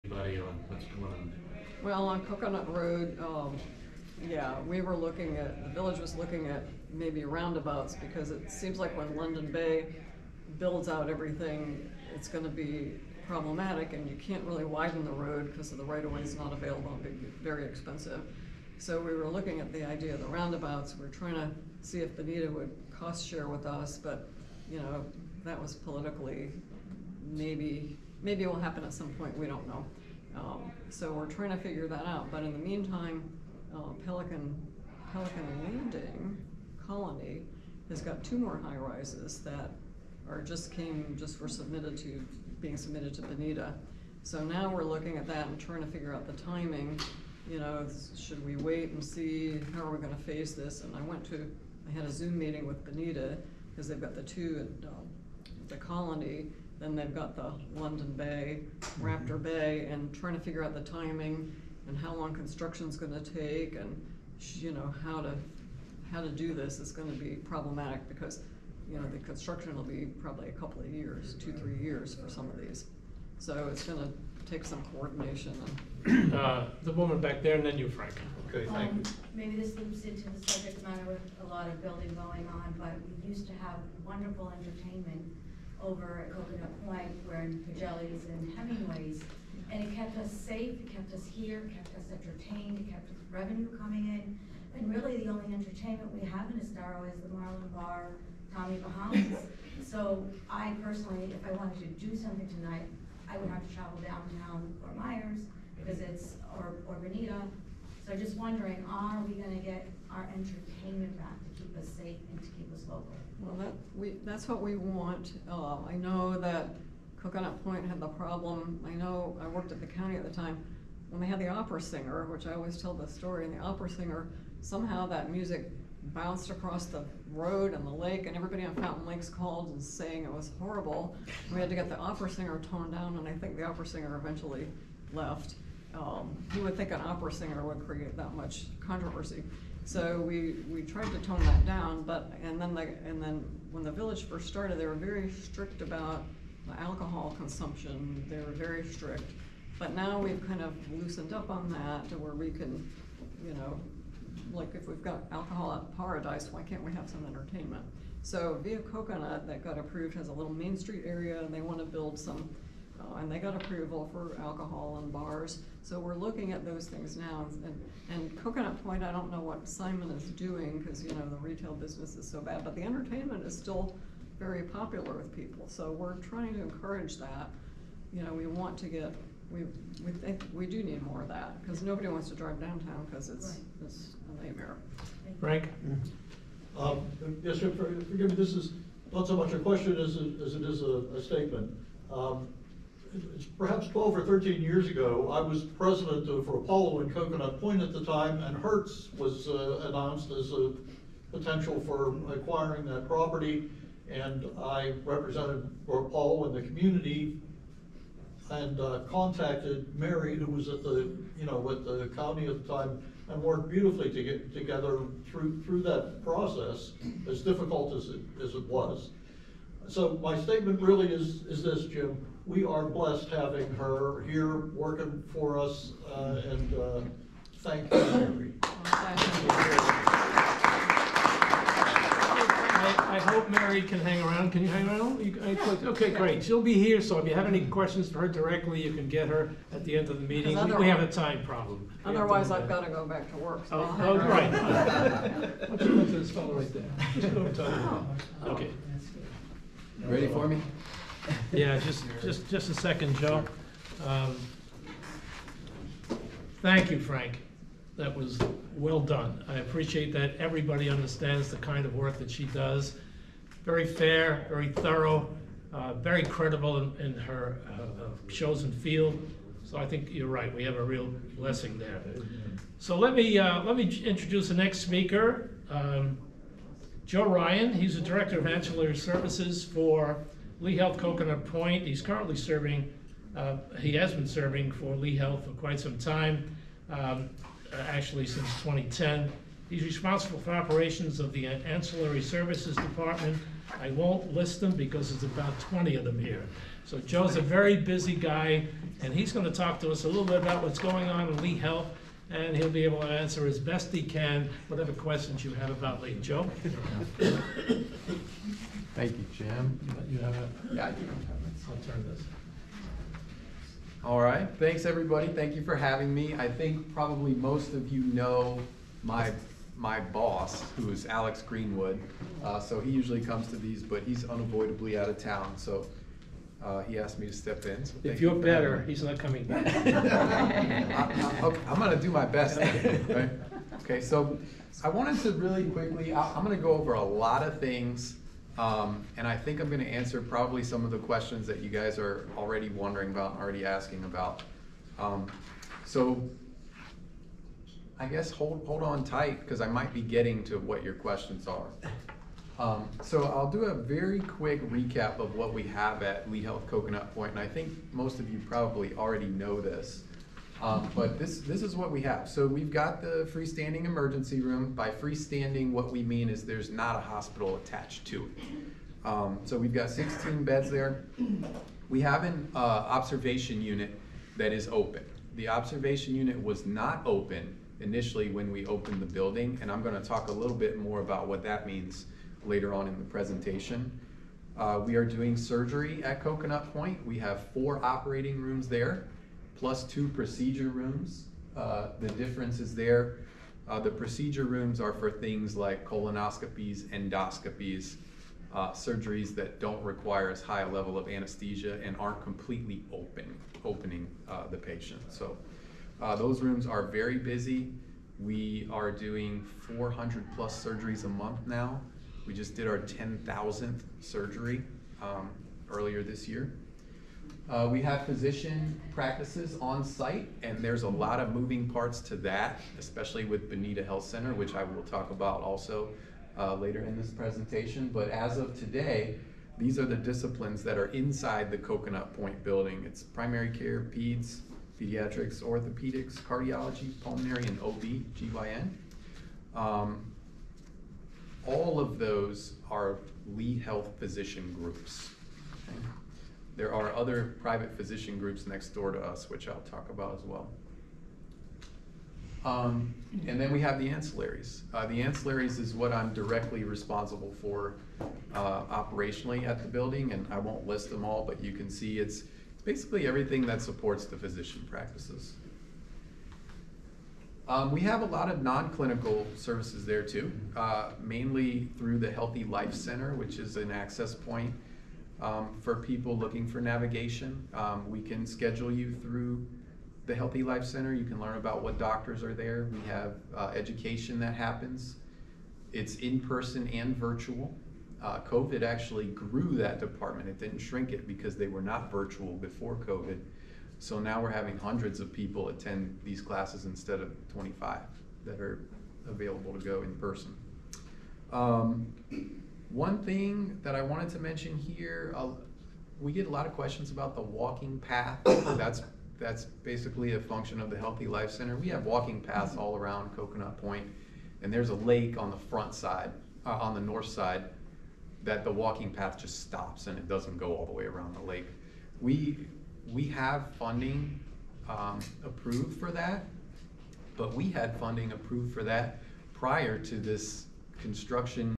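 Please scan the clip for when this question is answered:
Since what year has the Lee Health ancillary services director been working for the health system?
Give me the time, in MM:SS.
04:48.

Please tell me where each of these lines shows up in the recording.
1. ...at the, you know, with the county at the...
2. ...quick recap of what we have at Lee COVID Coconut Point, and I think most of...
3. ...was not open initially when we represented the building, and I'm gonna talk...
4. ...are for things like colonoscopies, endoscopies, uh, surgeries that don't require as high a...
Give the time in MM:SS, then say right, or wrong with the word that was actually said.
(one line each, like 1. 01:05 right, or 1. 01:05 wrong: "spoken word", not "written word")
1. 03:30 right
2. 05:54 wrong: "Health", not "COVID"
3. 06:16 wrong: "opened", not "represented"
4. 06:34 right.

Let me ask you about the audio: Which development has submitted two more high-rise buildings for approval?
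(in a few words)
Pelican Landing Colony.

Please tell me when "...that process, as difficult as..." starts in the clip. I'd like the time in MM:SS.
03:35.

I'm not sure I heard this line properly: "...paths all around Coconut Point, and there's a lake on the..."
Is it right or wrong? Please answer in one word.
right.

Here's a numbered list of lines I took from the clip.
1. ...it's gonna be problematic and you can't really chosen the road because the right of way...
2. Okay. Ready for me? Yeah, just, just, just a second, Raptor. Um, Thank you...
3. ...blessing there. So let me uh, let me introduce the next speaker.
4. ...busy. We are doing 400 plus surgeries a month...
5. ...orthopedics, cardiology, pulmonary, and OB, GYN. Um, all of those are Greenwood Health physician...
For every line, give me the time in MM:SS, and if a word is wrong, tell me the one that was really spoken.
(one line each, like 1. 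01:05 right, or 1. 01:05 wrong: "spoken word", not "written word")
1. 00:12 wrong: "widen", not "chosen"
2. 04:08 wrong: "Joe", not "Raptor"
3. 04:31 right
4. 06:47 right
5. 07:15 wrong: "Lee", not "Greenwood".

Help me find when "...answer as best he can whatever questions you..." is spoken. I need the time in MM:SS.
05:03.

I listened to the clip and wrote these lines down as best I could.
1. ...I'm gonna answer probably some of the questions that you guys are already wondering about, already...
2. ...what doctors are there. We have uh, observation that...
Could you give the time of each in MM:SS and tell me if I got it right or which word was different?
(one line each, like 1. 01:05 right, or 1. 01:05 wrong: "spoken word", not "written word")
1. 05:39 right
2. 08:01 wrong: "education", not "observation".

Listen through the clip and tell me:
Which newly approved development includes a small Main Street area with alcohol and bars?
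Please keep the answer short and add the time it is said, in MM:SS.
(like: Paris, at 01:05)
Via Coconut, at 02:38.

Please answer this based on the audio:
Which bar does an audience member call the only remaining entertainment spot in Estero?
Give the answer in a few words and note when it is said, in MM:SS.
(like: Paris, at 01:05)
Marlin Bar, at 01:37.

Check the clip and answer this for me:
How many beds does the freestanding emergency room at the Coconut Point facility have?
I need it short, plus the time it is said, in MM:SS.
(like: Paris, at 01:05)
16, at 06:09.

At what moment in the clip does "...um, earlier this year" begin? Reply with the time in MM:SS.
06:55.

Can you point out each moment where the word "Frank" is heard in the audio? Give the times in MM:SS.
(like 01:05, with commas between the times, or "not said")
01:17, 03:05, 04:16.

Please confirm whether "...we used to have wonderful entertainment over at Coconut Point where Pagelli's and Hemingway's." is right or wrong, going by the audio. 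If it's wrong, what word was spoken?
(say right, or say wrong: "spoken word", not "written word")
right.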